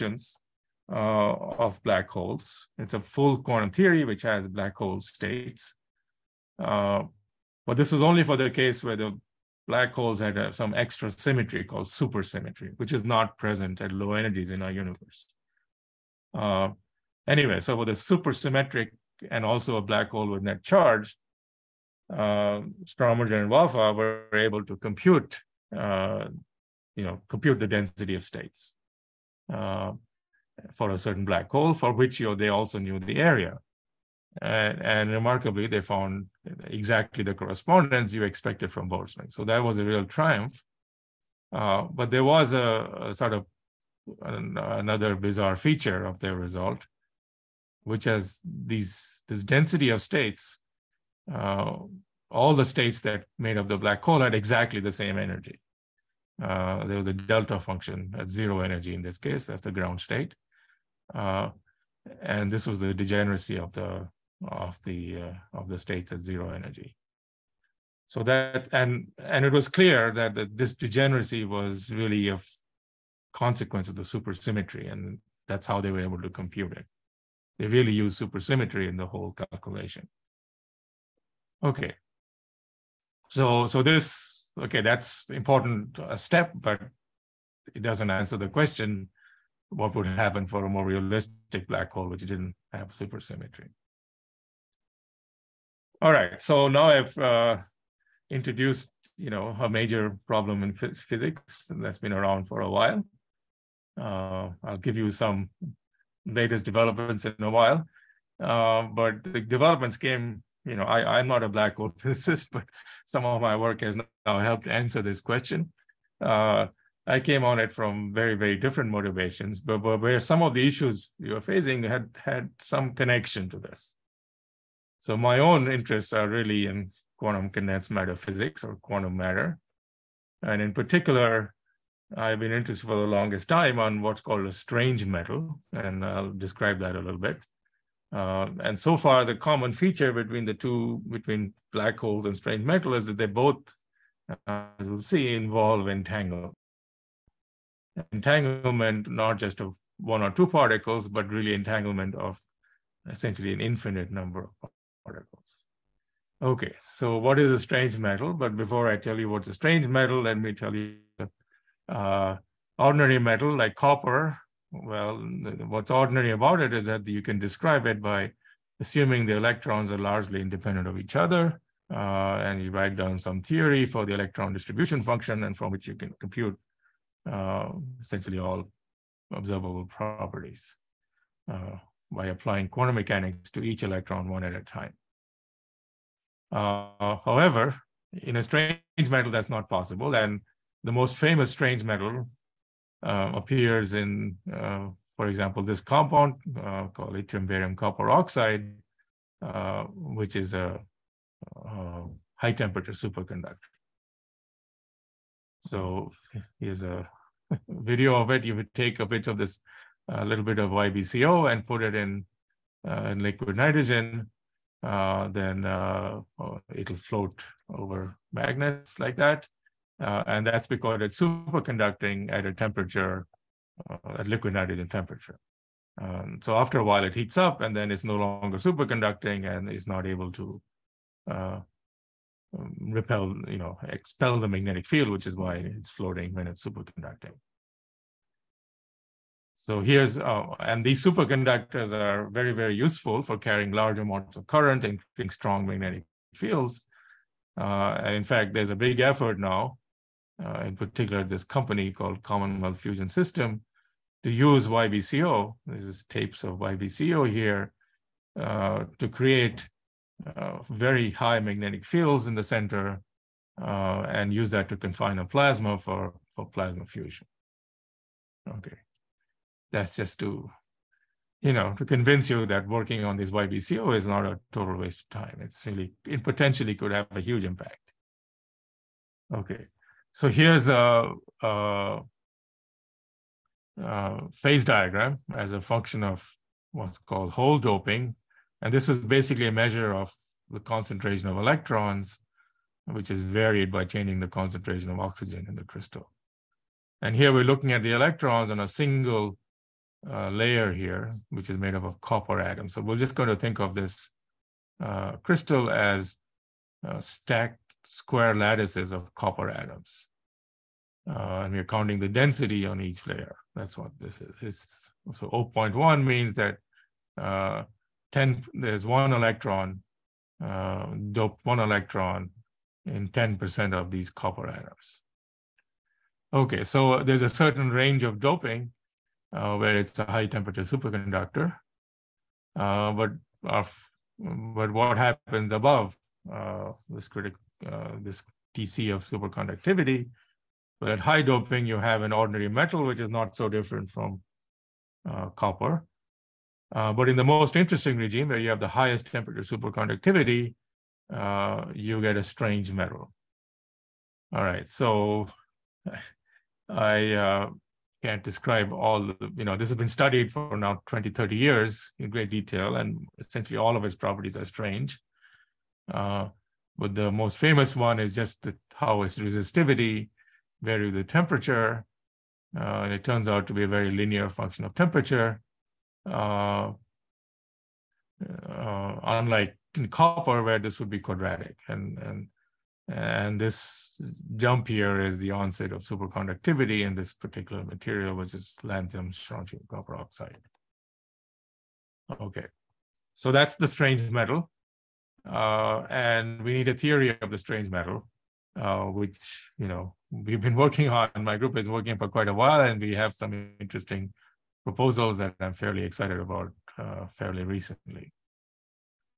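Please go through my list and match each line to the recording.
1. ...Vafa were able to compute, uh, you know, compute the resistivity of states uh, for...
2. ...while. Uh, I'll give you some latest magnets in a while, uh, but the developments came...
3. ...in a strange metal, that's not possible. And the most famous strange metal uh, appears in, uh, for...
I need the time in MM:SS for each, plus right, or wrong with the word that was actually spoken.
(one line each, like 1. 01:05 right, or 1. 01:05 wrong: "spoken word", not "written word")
1. 00:22 wrong: "density", not "resistivity"
2. 01:42 wrong: "developments", not "magnets"
3. 03:08 right.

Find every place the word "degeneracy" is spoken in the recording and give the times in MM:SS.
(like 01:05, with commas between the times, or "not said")
01:02, 01:10.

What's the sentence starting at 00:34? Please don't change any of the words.
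And, and, remarkably, they found exactly the correspondence you expected from Boltzmann.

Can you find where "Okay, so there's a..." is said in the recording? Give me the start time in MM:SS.
05:26.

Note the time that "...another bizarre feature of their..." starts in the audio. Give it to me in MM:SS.
00:44.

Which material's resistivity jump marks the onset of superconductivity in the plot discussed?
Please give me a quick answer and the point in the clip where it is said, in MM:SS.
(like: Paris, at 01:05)
lanthanum strontium copper oxide, at 06:28.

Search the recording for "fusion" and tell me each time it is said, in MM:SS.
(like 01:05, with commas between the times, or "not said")
04:12, 04:26.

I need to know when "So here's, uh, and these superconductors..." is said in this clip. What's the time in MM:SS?
03:59.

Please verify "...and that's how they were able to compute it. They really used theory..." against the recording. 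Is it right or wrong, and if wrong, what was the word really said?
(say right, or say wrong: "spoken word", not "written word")
wrong: "supersymmetry", not "theory".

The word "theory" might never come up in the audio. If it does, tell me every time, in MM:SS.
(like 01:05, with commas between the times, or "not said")
00:03, 02:53, 06:36.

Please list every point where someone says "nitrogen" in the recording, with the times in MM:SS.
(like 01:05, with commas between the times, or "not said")
03:33, 03:44.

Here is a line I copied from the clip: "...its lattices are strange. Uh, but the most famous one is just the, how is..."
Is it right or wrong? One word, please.
wrong.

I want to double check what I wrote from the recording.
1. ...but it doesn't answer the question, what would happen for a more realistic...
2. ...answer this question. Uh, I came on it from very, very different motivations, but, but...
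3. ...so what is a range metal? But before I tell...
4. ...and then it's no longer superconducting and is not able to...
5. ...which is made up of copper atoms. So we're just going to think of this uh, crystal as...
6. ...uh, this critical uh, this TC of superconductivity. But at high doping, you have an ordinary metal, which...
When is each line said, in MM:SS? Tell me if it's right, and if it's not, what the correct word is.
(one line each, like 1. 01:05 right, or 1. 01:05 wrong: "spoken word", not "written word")
1. 01:26 right
2. 01:54 right
3. 02:36 wrong: "strange", not "range"
4. 03:47 right
5. 05:01 right
6. 05:36 right.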